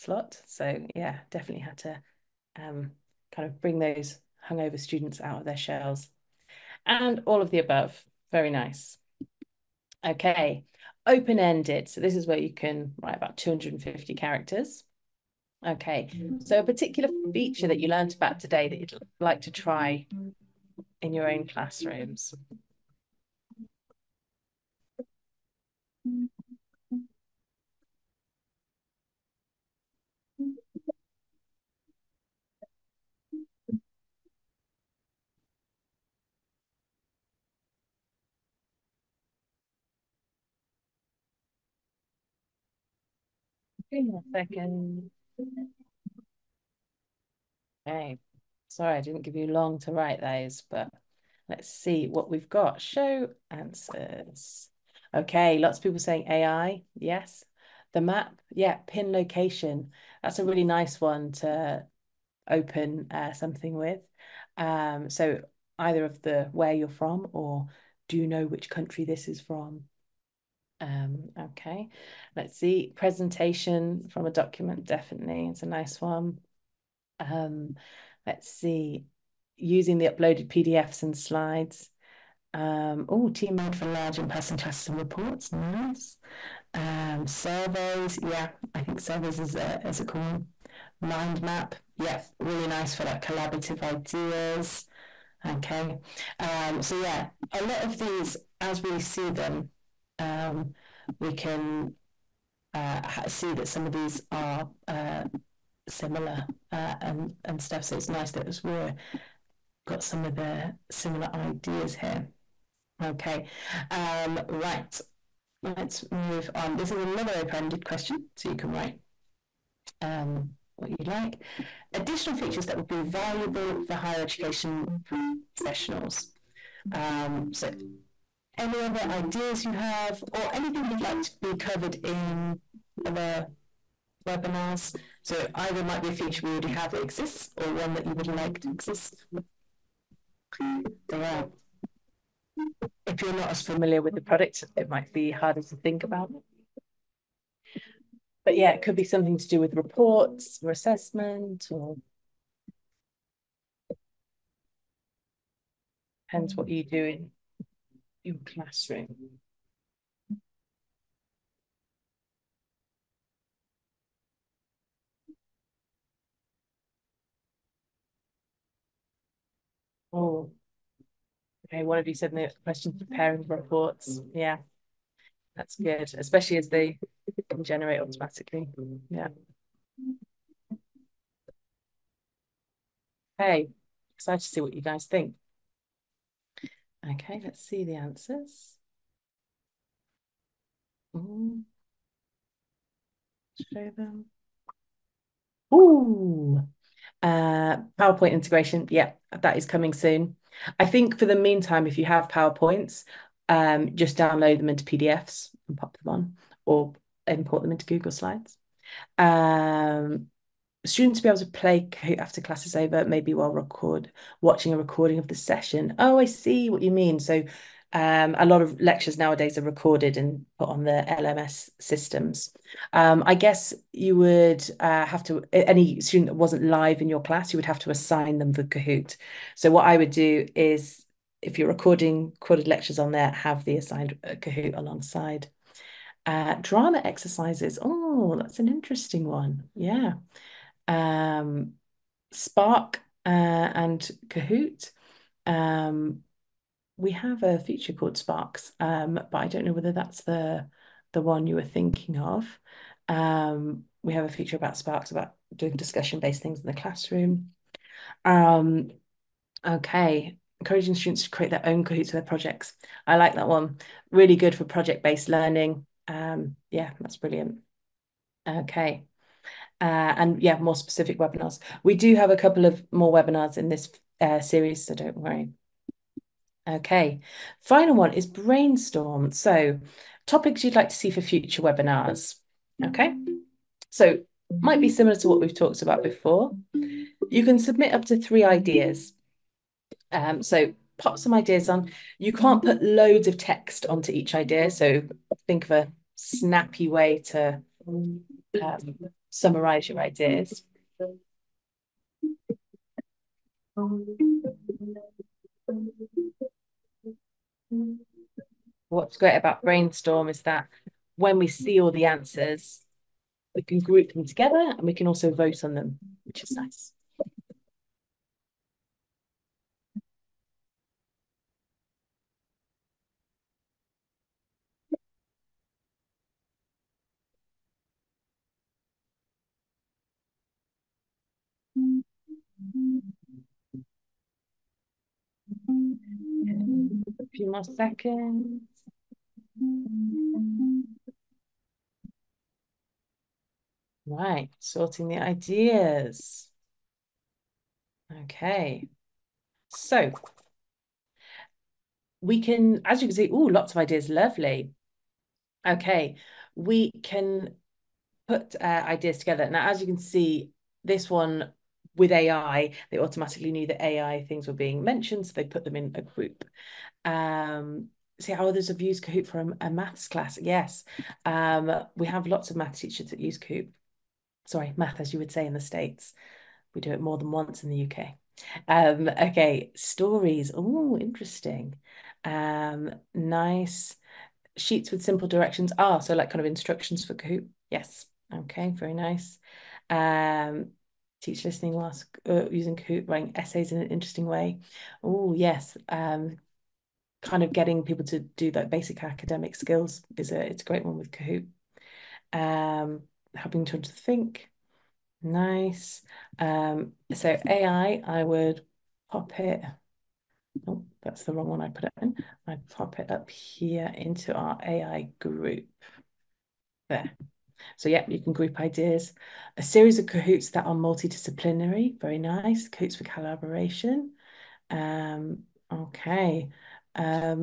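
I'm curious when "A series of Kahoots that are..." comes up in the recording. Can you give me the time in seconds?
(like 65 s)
419 s.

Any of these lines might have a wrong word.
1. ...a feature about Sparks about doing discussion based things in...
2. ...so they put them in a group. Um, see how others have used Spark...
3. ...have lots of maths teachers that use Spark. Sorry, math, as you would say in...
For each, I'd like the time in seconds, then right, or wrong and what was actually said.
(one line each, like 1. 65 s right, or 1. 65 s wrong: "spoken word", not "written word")
1. 254 s right
2. 365 s wrong: "Kahoot", not "Spark"
3. 372 s wrong: "Kahoot", not "Spark".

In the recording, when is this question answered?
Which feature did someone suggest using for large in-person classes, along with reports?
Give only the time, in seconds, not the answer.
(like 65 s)
83 s.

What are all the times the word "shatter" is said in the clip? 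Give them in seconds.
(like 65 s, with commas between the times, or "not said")
not said.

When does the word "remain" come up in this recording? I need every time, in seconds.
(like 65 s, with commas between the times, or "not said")
not said.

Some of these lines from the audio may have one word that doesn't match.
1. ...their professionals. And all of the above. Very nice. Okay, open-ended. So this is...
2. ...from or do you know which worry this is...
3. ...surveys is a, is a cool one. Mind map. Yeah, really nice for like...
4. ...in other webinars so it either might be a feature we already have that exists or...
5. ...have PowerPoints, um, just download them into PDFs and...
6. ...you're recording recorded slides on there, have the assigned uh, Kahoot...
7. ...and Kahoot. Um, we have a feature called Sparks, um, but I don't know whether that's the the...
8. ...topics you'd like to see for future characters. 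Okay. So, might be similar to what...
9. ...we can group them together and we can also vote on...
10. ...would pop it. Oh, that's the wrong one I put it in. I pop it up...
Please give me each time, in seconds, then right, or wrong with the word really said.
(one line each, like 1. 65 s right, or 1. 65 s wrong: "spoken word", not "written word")
1. 5 s wrong: "shells", not "professionals"
2. 66 s wrong: "country", not "worry"
3. 88 s right
4. 132 s right
5. 202 s right
6. 231 s wrong: "lectures", not "slides"
7. 243 s right
8. 280 s wrong: "webinars", not "characters"
9. 313 s right
10. 408 s right.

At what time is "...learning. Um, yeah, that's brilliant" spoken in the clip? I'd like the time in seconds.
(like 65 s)
265 s.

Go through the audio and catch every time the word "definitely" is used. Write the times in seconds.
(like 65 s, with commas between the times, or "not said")
1 s, 74 s.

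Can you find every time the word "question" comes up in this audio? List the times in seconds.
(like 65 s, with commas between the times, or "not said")
117 s, 172 s.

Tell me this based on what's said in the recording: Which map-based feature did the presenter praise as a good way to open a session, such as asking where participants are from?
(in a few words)
Pin location.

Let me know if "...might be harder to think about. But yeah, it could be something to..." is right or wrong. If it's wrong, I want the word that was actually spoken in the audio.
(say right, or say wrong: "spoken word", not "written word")
right.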